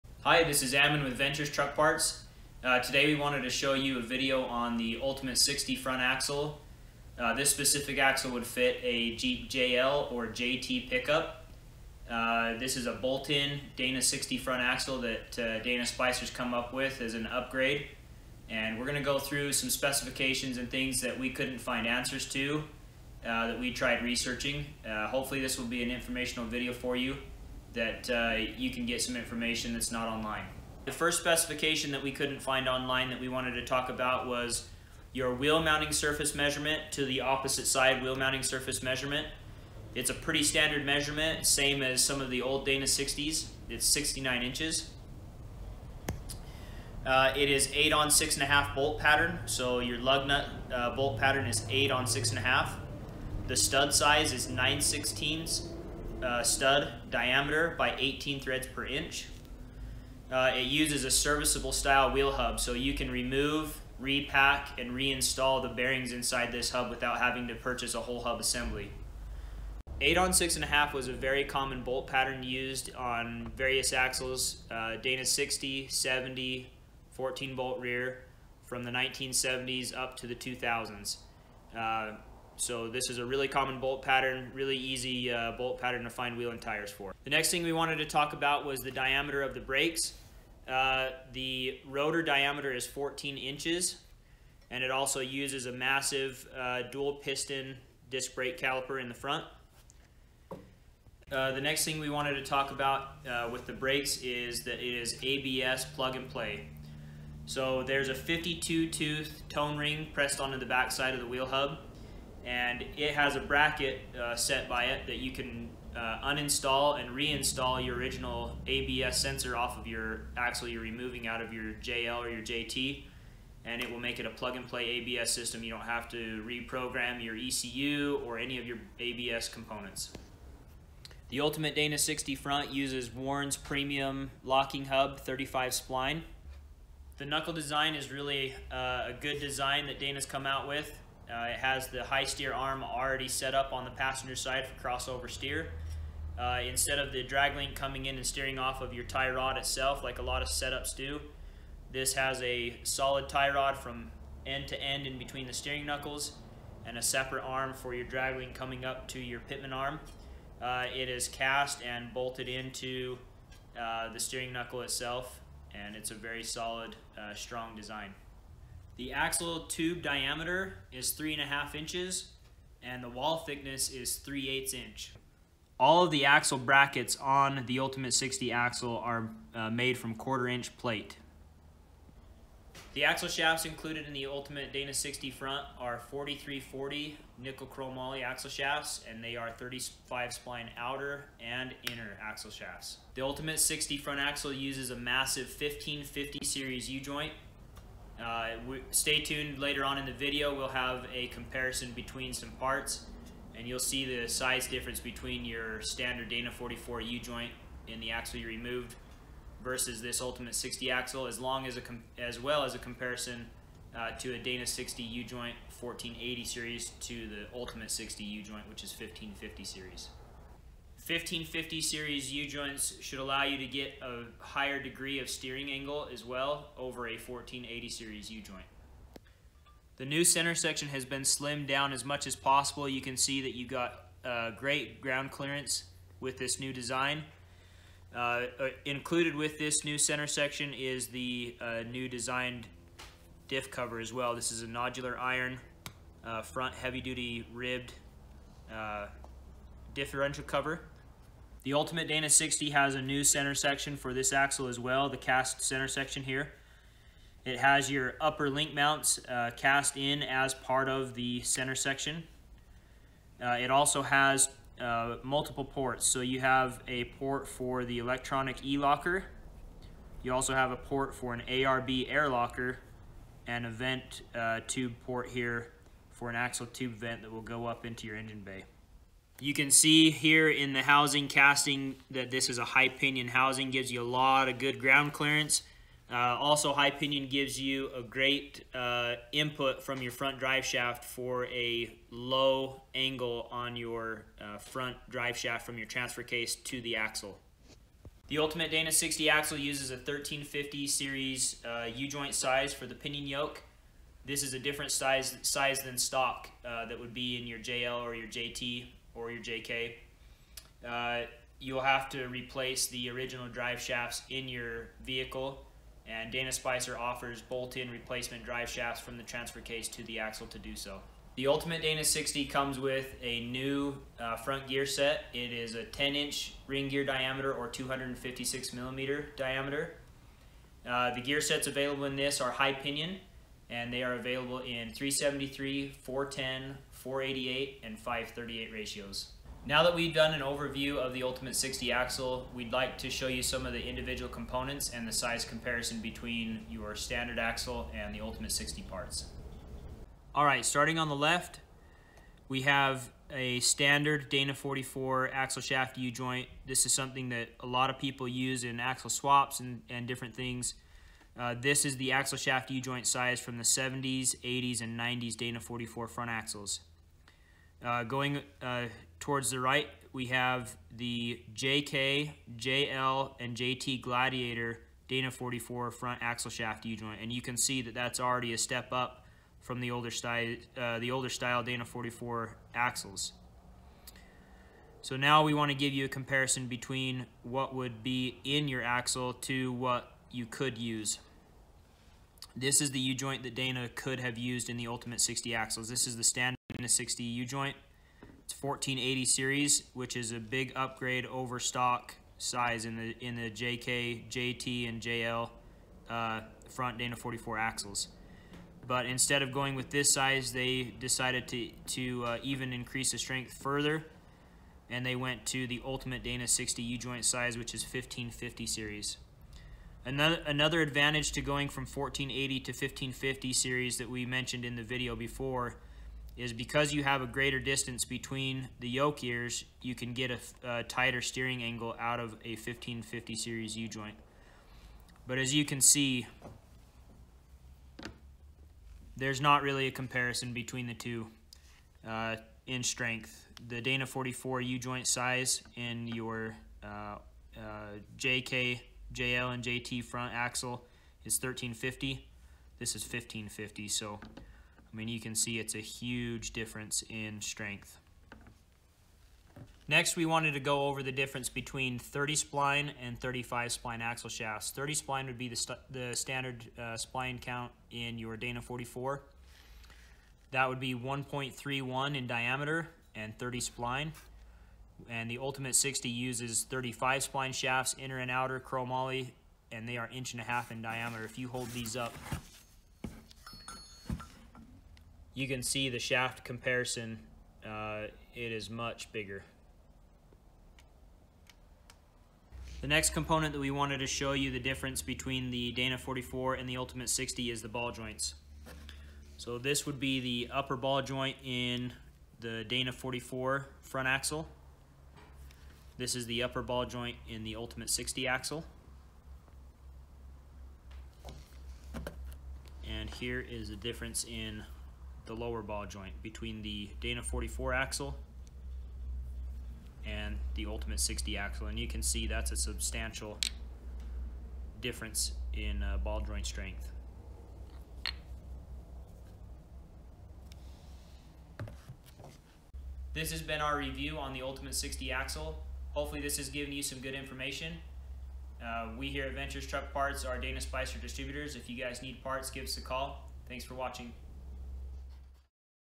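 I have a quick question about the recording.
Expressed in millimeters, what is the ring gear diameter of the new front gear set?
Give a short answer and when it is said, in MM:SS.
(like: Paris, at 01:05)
256 millimeters, at 05:27.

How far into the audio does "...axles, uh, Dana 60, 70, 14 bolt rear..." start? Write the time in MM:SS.
01:13.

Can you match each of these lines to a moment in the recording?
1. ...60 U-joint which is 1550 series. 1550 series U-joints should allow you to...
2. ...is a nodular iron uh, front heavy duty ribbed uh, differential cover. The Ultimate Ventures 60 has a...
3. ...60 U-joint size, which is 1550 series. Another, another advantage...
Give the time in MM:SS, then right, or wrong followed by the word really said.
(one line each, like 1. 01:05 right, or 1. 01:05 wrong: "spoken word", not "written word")
1. 03:37 right
2. 04:04 wrong: "Dana", not "Ventures"
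3. 06:56 right.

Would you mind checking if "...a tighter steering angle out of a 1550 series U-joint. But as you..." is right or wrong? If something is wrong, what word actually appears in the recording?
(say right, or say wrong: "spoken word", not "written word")
right.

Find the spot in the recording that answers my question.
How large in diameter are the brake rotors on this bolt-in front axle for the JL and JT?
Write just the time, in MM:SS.
01:32.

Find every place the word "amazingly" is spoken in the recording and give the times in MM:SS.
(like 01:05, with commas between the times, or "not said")
not said.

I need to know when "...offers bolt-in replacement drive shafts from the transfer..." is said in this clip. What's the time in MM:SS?
05:16.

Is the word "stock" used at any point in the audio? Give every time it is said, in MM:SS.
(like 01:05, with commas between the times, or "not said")
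05:05, 06:41.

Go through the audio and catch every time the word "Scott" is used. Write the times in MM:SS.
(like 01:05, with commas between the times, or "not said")
not said.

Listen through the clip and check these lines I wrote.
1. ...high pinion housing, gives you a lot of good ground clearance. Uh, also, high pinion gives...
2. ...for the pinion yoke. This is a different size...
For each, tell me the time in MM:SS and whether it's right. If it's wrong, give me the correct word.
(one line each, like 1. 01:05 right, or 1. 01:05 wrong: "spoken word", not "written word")
1. 04:42 right
2. 05:02 right.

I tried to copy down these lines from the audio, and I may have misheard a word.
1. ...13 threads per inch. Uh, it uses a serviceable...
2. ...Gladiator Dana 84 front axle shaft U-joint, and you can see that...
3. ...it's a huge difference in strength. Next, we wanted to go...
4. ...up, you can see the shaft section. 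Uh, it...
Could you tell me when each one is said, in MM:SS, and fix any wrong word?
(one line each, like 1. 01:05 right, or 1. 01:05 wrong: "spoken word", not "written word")
1. 00:57 wrong: "18", not "13"
2. 06:14 wrong: "44", not "84"
3. 07:35 right
4. 08:01 wrong: "comparison", not "section".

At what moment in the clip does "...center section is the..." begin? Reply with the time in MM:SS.
03:59.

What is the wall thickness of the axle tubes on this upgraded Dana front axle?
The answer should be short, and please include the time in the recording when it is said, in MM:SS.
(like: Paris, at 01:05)
3/8 inch, at 02:54.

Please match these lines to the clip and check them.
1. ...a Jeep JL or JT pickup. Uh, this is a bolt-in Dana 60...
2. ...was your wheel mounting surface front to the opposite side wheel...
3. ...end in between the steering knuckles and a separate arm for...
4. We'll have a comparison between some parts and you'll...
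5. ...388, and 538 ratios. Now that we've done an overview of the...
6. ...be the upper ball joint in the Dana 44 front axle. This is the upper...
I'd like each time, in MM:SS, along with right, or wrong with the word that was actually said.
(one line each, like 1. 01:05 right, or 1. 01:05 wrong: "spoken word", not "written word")
1. 00:08 right
2. 00:34 wrong: "measurement", not "front"
3. 02:34 right
4. 03:20 right
5. 05:36 wrong: "488", not "388"
6. 08:19 right.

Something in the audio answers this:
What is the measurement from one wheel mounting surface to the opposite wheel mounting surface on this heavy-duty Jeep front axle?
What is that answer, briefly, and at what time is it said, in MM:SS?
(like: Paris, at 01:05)
69 inches, at 00:43.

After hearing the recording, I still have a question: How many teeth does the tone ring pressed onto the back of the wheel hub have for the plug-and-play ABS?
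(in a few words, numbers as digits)
52.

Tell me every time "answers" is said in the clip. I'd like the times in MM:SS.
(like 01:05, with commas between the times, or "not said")
00:21.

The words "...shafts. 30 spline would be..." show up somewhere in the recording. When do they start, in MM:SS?
07:44.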